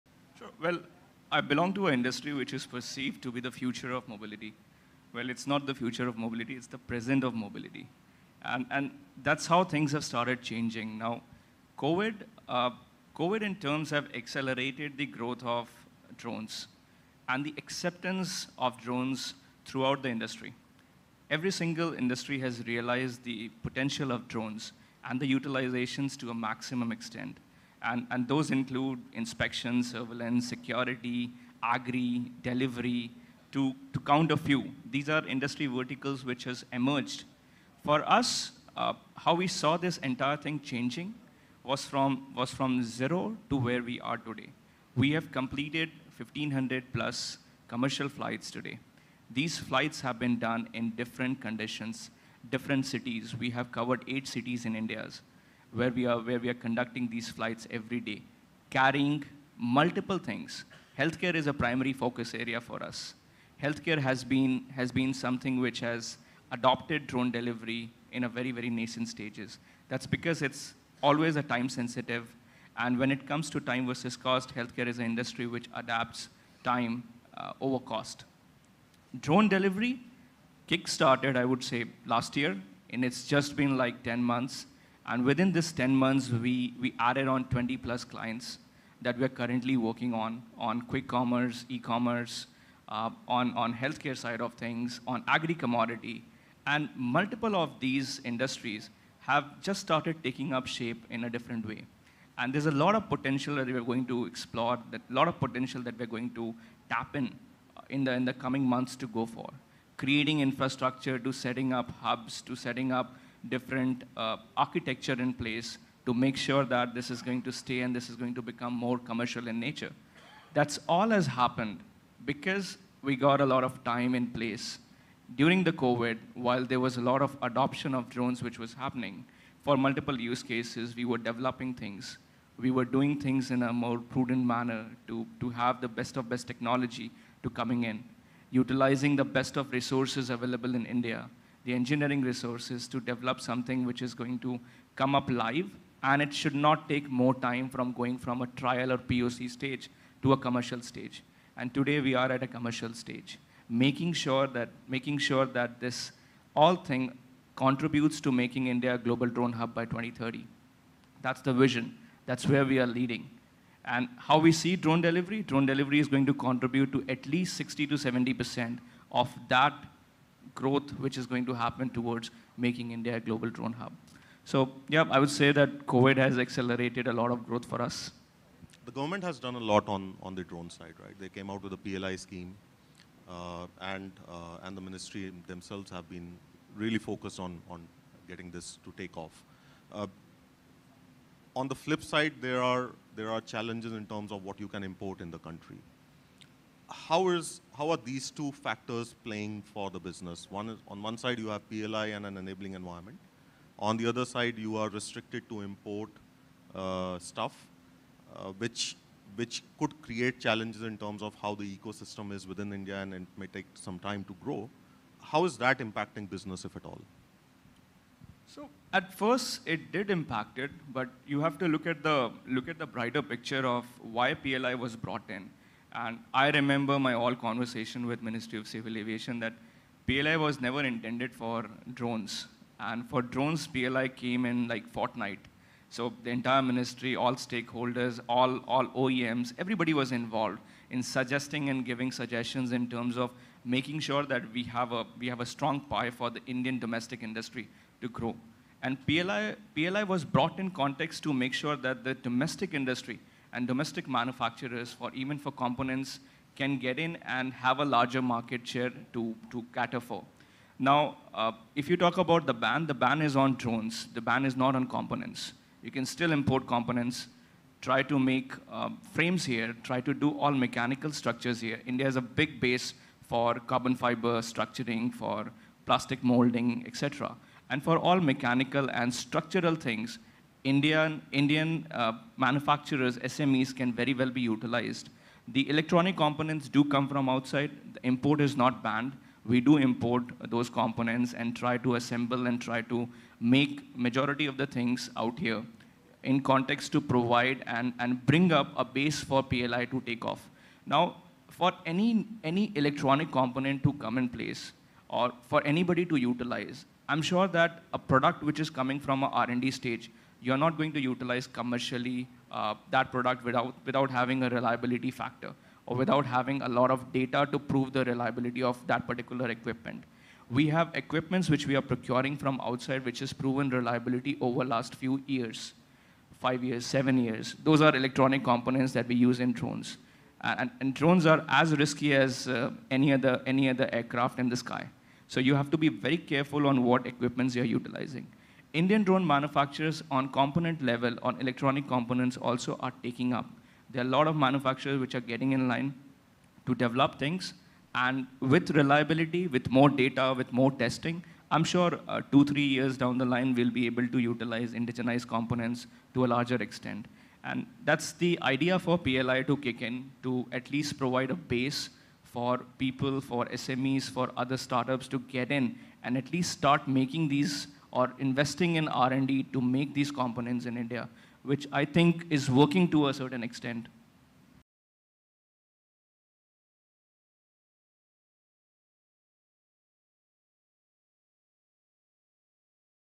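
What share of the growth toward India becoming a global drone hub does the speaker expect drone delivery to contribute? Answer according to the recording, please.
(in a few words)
60 to 70%.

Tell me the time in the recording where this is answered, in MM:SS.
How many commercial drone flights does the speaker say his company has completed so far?
00:46.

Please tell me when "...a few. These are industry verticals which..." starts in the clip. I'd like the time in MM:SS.
00:34.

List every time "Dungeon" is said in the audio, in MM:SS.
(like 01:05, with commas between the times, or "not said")
not said.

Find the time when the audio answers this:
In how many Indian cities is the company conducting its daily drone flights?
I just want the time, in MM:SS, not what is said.
00:54.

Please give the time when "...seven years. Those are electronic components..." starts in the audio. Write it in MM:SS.
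05:26.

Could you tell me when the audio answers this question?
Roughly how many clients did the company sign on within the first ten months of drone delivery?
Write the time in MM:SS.
01:27.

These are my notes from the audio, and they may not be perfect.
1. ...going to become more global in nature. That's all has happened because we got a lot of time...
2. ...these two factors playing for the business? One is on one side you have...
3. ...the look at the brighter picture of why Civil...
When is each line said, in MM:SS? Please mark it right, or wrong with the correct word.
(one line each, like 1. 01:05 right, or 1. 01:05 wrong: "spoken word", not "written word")
1. 01:58 wrong: "commercial", not "global"
2. 03:18 right
3. 03:42 wrong: "PLI", not "Civil".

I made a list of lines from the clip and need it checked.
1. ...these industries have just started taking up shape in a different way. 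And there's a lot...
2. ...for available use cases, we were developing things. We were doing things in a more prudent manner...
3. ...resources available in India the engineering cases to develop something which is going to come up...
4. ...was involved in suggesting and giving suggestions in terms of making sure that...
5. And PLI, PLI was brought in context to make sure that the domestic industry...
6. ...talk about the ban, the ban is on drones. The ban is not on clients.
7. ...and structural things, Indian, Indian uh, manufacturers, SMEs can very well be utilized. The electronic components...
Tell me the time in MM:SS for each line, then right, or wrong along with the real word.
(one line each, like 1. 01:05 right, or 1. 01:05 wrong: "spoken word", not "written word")
1. 01:37 right
2. 02:09 wrong: "multiple", not "available"
3. 02:19 wrong: "resources", not "cases"
4. 03:59 right
5. 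04:08 right
6. 04:21 wrong: "components", not "clients"
7. 04:38 right.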